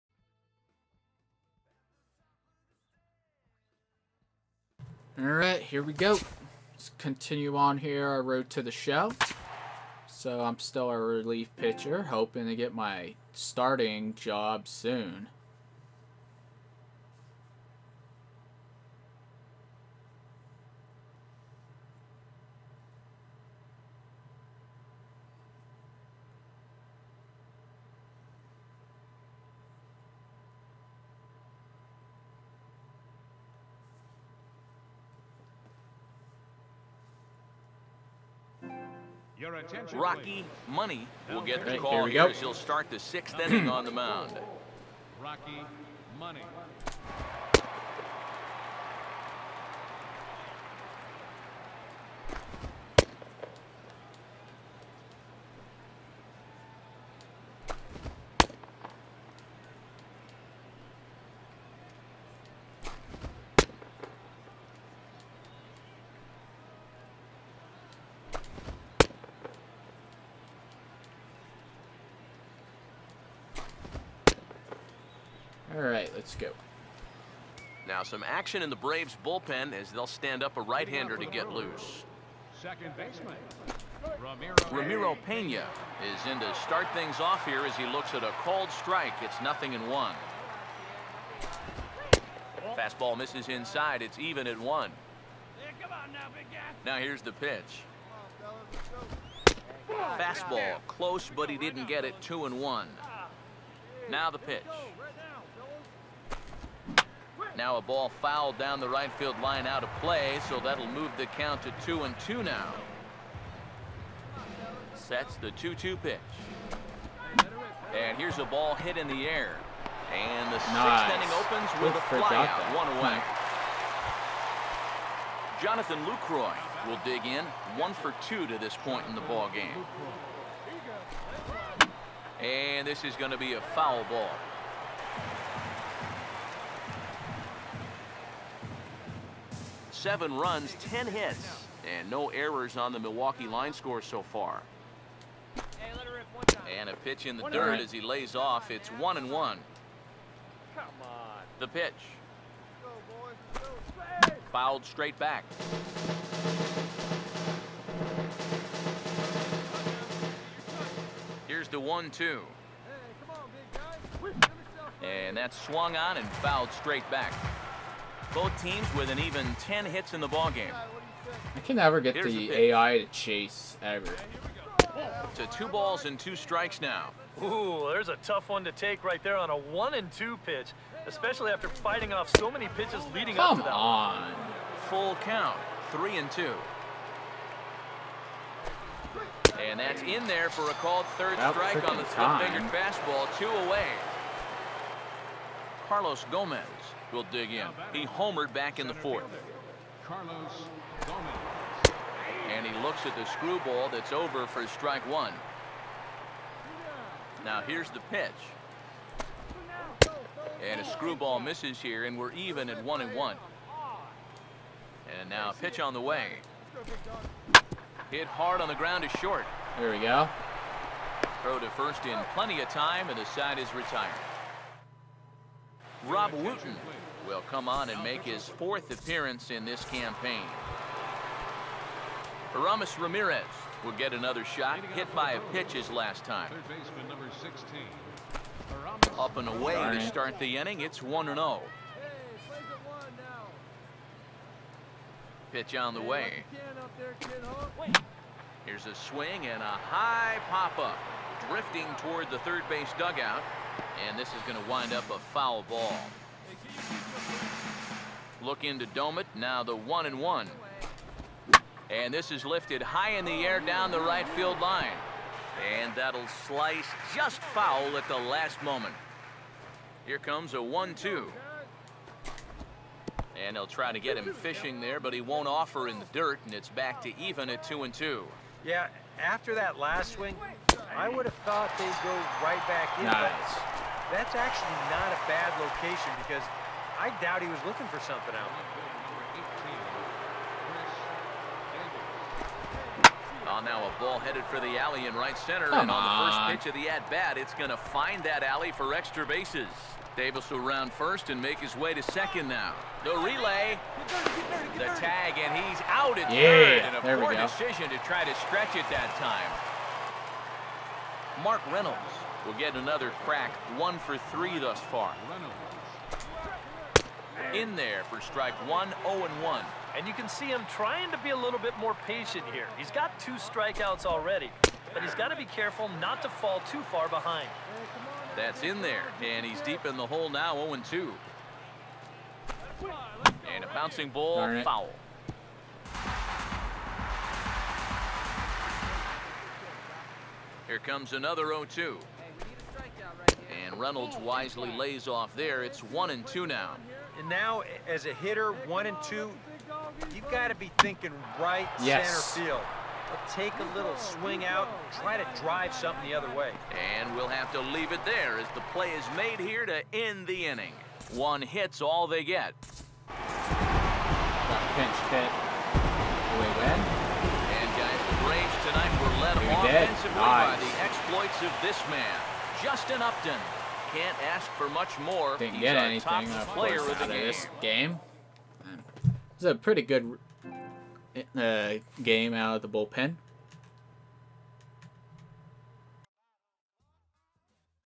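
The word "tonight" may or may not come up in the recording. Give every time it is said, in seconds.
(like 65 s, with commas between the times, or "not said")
368 s.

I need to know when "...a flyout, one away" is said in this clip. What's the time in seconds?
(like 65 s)
122 s.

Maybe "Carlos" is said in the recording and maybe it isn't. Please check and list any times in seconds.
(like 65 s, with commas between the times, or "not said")
195 s, 200 s.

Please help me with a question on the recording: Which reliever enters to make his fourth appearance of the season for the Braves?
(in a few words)
Rob Wooten.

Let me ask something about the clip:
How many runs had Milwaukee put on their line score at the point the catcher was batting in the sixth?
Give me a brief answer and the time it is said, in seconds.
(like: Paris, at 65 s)
7, at 140 s.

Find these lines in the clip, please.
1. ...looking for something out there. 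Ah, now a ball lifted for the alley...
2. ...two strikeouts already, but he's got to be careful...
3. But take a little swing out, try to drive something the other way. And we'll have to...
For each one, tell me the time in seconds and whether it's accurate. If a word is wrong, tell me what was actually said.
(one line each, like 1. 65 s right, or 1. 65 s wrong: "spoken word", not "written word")
1. 287 s wrong: "headed", not "lifted"
2. 323 s right
3. 353 s right.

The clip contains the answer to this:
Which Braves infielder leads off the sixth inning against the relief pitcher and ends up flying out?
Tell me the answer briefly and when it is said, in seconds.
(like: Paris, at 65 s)
Ramiro Pena, at 84 s.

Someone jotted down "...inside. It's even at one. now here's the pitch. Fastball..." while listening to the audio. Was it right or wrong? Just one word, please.
right.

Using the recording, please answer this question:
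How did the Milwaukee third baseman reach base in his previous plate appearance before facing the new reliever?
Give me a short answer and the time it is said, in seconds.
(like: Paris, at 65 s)
Hit by a pitch, at 234 s.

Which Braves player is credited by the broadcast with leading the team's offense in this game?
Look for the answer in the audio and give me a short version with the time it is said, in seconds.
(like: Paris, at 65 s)
Justin Upton, at 372 s.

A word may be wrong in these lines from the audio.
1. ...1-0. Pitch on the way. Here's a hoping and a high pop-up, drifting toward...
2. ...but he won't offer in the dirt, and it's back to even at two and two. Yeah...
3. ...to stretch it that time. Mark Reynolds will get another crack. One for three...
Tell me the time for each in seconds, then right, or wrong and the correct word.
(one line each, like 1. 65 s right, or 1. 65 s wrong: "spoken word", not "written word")
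1. 240 s wrong: "swing", not "hoping"
2. 274 s right
3. 308 s right.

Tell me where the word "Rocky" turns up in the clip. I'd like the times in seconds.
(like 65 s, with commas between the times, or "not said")
39 s, 45 s.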